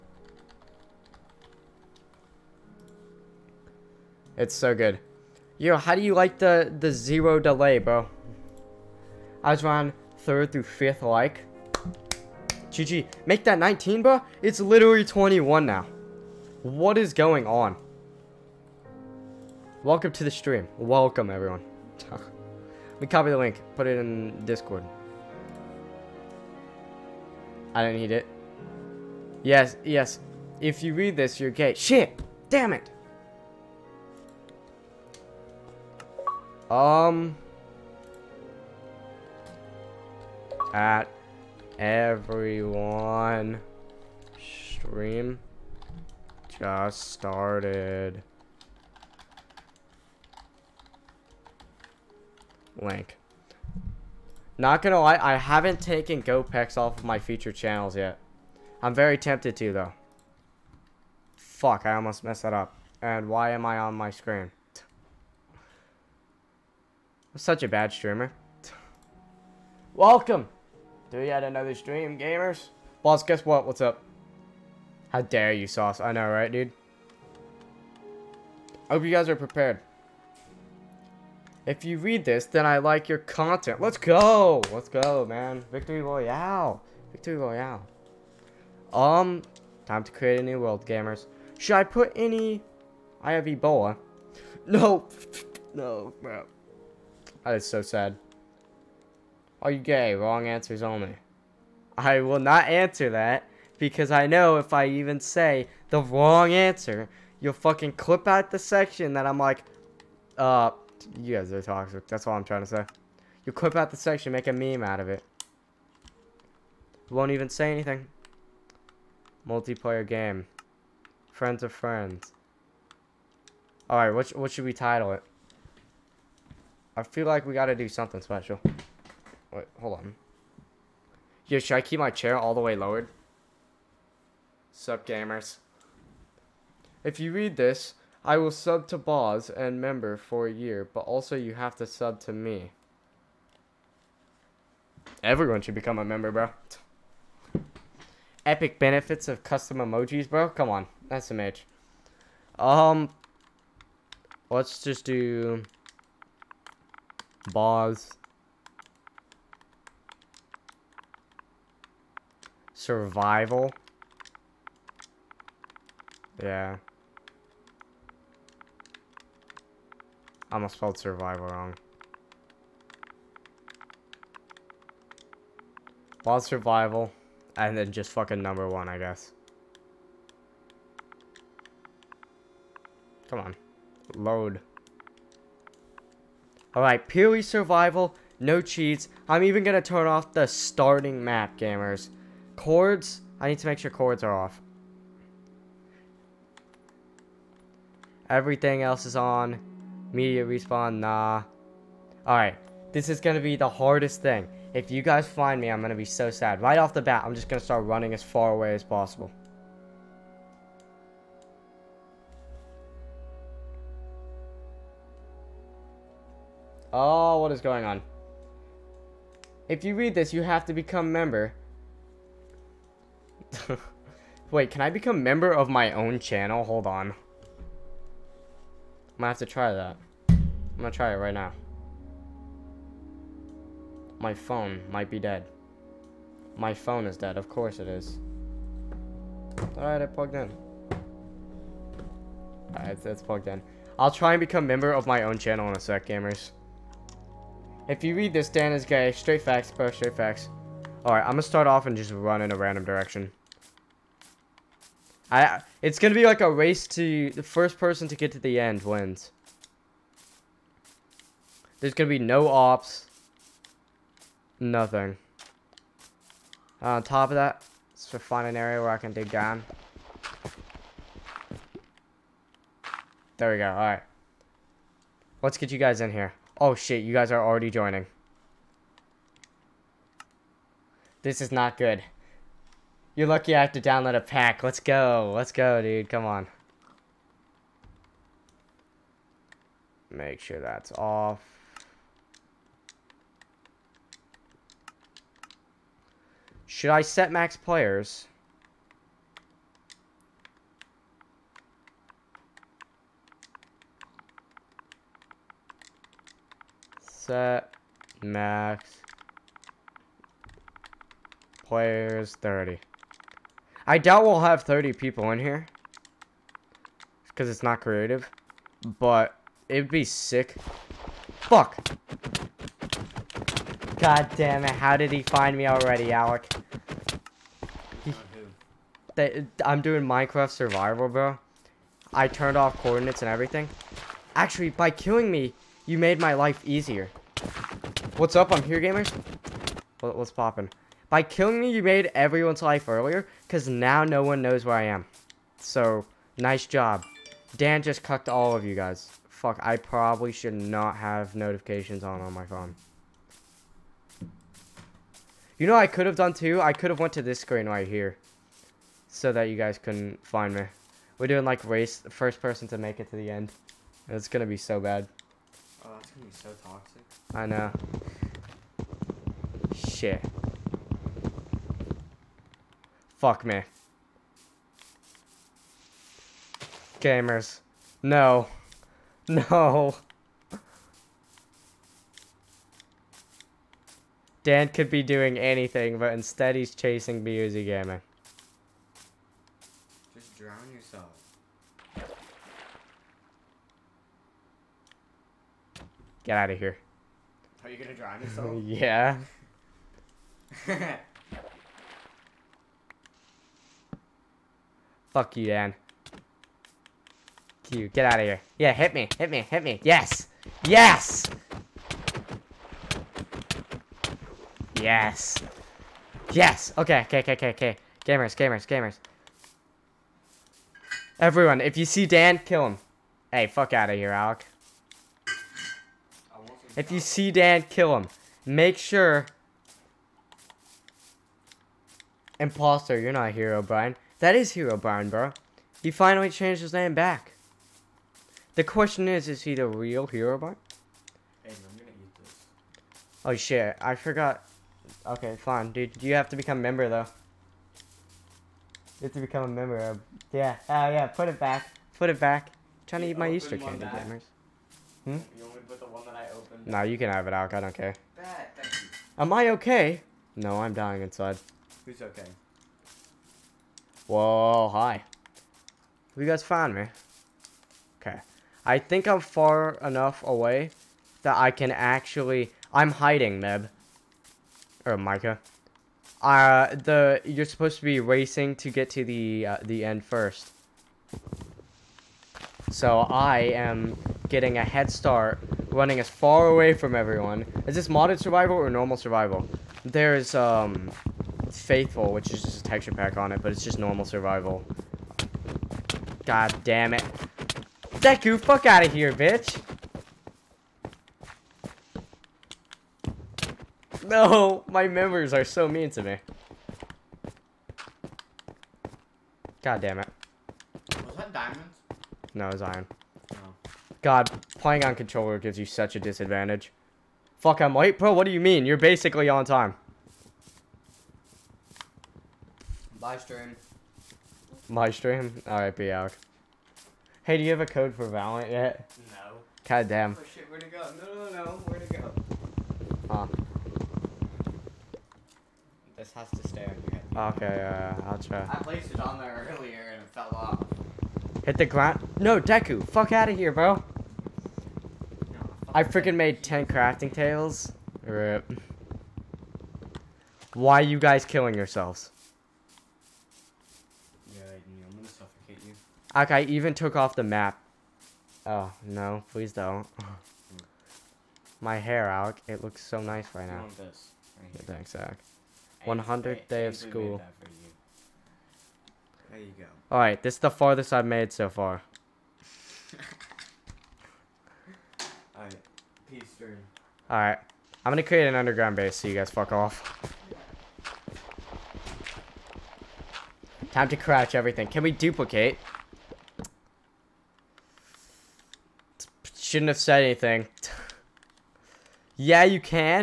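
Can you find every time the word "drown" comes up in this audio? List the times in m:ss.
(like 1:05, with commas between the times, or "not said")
6:30, 6:37.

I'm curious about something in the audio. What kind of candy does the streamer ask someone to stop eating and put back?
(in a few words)
Easter candy.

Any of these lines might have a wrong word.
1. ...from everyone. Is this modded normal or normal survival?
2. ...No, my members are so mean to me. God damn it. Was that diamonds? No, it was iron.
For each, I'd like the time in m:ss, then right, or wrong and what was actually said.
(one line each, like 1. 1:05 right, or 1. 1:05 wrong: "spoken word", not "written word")
1. 8:06 wrong: "survival", not "normal"
2. 8:24 right.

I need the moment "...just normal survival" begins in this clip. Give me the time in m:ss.
8:13.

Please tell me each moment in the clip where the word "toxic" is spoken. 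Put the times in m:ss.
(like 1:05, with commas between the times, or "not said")
1:51, 6:06.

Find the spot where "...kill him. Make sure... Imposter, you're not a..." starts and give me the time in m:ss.
7:07.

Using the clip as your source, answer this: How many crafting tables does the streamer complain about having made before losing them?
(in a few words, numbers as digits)
10.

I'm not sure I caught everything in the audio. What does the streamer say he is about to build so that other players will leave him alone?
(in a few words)
underground base.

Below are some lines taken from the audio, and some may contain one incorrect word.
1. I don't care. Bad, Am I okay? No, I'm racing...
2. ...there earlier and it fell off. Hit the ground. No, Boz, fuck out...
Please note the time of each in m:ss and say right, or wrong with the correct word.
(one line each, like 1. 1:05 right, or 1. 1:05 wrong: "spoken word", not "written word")
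1. 7:37 wrong: "dying", not "racing"
2. 8:59 wrong: "Deku", not "Boz".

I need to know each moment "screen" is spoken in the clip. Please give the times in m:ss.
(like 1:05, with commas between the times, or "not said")
1:04, 5:57.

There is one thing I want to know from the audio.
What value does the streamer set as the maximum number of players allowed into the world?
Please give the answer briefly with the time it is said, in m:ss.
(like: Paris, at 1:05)
30, at 5:11.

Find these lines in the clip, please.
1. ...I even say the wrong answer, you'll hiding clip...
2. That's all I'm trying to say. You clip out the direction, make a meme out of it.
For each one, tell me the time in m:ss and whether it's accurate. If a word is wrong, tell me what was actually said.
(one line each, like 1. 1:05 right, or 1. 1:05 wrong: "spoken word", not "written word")
1. 1:44 wrong: "fucking", not "hiding"
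2. 1:52 wrong: "section", not "direction".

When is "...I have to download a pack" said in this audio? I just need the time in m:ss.
4:43.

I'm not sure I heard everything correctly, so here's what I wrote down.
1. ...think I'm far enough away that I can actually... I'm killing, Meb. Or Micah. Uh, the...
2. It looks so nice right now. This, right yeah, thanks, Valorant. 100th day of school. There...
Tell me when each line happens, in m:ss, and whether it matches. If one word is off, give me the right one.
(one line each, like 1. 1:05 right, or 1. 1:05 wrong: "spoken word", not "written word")
1. 7:48 wrong: "hiding", not "killing"
2. 9:22 wrong: "Zach", not "Valorant".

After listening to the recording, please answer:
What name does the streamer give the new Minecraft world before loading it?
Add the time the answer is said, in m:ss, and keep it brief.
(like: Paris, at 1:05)
Boz Survival, at 2:37.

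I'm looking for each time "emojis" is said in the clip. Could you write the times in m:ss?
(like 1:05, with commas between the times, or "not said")
2:29.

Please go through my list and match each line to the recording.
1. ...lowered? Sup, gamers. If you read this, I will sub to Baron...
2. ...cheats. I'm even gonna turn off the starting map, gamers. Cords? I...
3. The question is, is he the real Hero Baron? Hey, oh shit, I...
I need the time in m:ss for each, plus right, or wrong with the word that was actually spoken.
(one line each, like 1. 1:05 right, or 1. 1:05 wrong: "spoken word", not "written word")
1. 2:12 wrong: "Boz", not "Baron"
2. 3:08 right
3. 7:18 right.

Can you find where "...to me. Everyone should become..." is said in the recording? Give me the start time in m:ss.
2:22.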